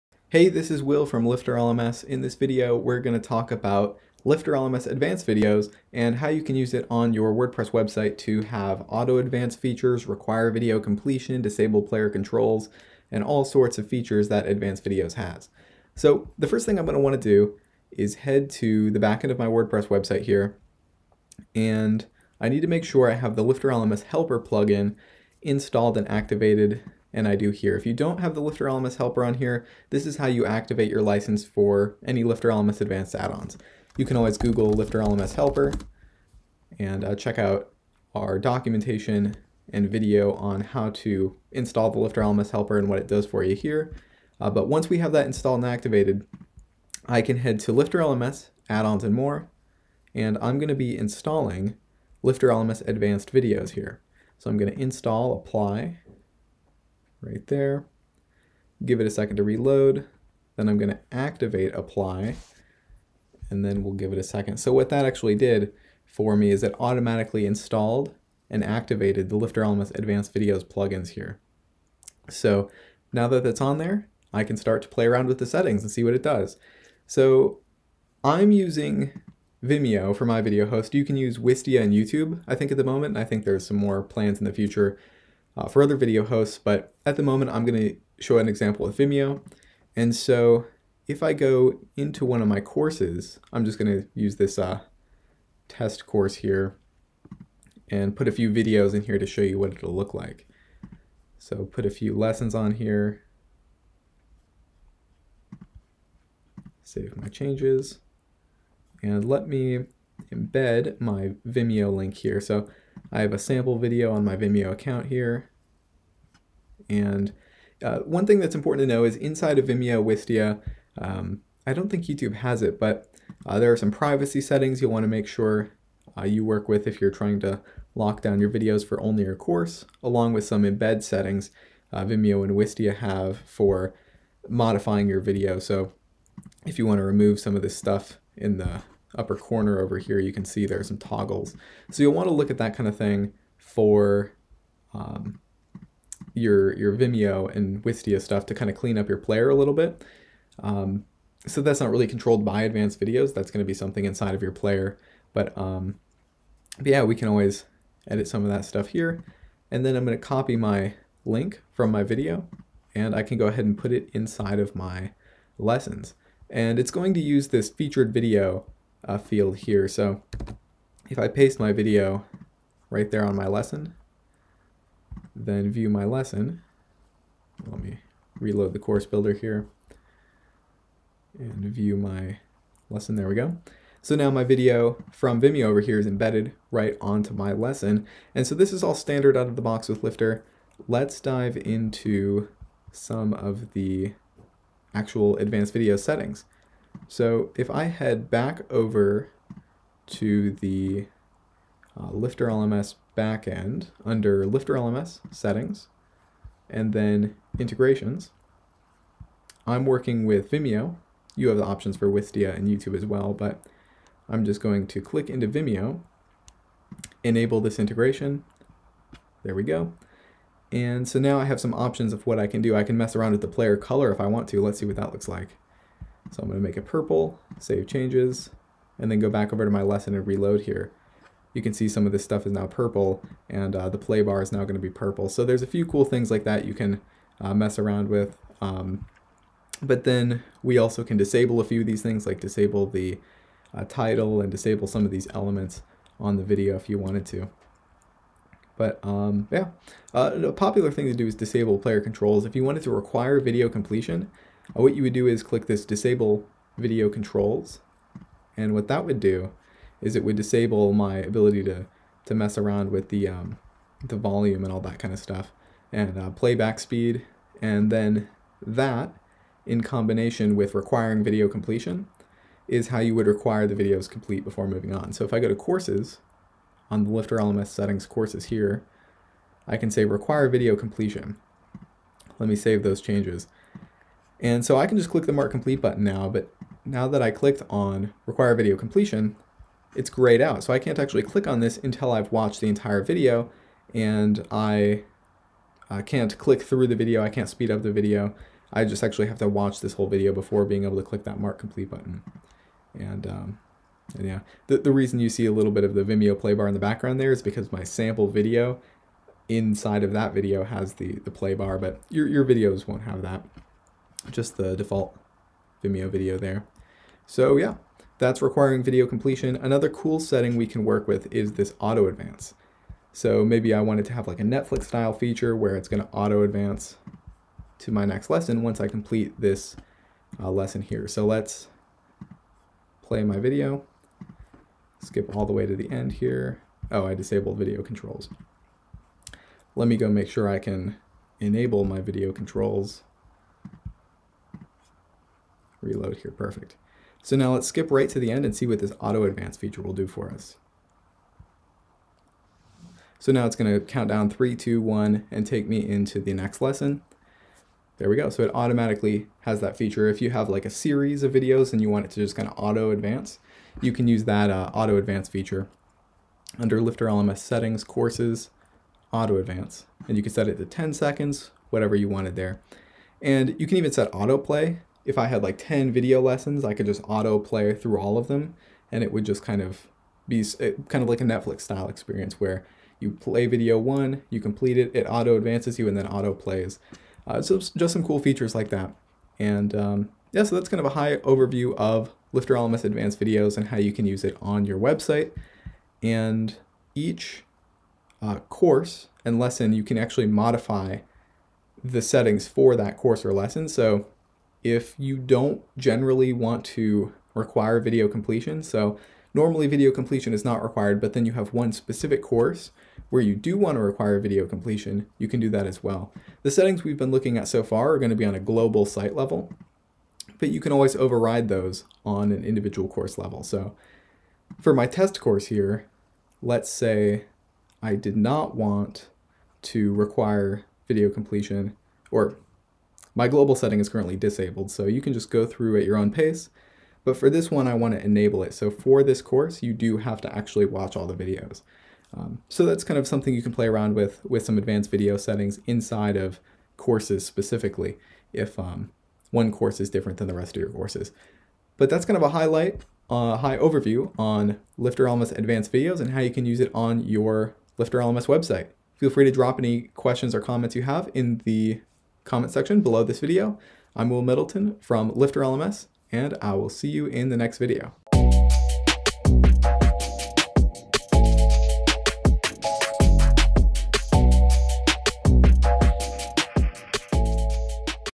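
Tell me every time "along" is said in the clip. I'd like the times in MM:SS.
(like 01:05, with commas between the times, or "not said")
02:10.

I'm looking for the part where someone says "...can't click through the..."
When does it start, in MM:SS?
04:56.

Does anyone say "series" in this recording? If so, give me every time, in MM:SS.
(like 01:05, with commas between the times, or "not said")
06:00.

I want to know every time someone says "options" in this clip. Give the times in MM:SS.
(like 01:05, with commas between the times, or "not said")
03:31, 03:41.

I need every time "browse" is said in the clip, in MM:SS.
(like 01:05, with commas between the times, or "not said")
not said.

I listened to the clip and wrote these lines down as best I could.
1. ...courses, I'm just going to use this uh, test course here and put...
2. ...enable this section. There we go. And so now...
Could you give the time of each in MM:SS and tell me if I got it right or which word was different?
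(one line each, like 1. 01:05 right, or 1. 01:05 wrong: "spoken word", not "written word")
1. 01:32 right
2. 03:37 wrong: "integration", not "section".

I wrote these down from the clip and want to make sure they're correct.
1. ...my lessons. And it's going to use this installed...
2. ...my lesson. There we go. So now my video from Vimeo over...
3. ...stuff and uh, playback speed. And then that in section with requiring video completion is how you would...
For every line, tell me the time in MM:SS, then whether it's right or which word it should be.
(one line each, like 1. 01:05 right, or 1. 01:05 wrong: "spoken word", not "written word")
1. 02:44 wrong: "featured", not "installed"
2. 03:01 right
3. 04:25 wrong: "combination", not "section".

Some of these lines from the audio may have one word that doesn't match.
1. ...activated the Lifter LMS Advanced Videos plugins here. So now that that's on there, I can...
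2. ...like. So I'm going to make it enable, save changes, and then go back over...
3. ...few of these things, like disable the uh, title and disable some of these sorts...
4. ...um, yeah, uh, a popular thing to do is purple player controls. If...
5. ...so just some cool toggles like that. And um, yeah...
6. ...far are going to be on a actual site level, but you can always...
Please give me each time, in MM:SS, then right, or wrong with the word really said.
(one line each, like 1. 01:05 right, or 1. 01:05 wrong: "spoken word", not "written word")
1. 01:08 right
2. 03:45 wrong: "purple", not "enable"
3. 04:01 wrong: "elements", not "sorts"
4. 04:09 wrong: "disable", not "purple"
5. 06:27 wrong: "features", not "toggles"
6. 06:57 wrong: "global", not "actual".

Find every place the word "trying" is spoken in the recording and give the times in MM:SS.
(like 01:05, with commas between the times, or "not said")
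02:07.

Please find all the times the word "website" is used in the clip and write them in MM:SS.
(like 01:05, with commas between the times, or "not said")
00:07, 00:19, 06:34, 07:38.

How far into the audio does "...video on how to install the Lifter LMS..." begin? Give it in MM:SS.
00:39.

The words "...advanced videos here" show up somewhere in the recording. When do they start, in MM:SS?
00:52.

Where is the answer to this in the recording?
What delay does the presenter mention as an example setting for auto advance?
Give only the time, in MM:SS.
06:10.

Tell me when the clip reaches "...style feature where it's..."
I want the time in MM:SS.
05:24.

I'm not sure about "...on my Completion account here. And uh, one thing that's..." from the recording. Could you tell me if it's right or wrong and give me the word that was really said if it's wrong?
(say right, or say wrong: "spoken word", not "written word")
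wrong: "Vimeo", not "Completion".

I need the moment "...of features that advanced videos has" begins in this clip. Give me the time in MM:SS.
00:13.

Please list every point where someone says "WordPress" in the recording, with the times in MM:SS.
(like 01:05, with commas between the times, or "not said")
00:07, 00:19.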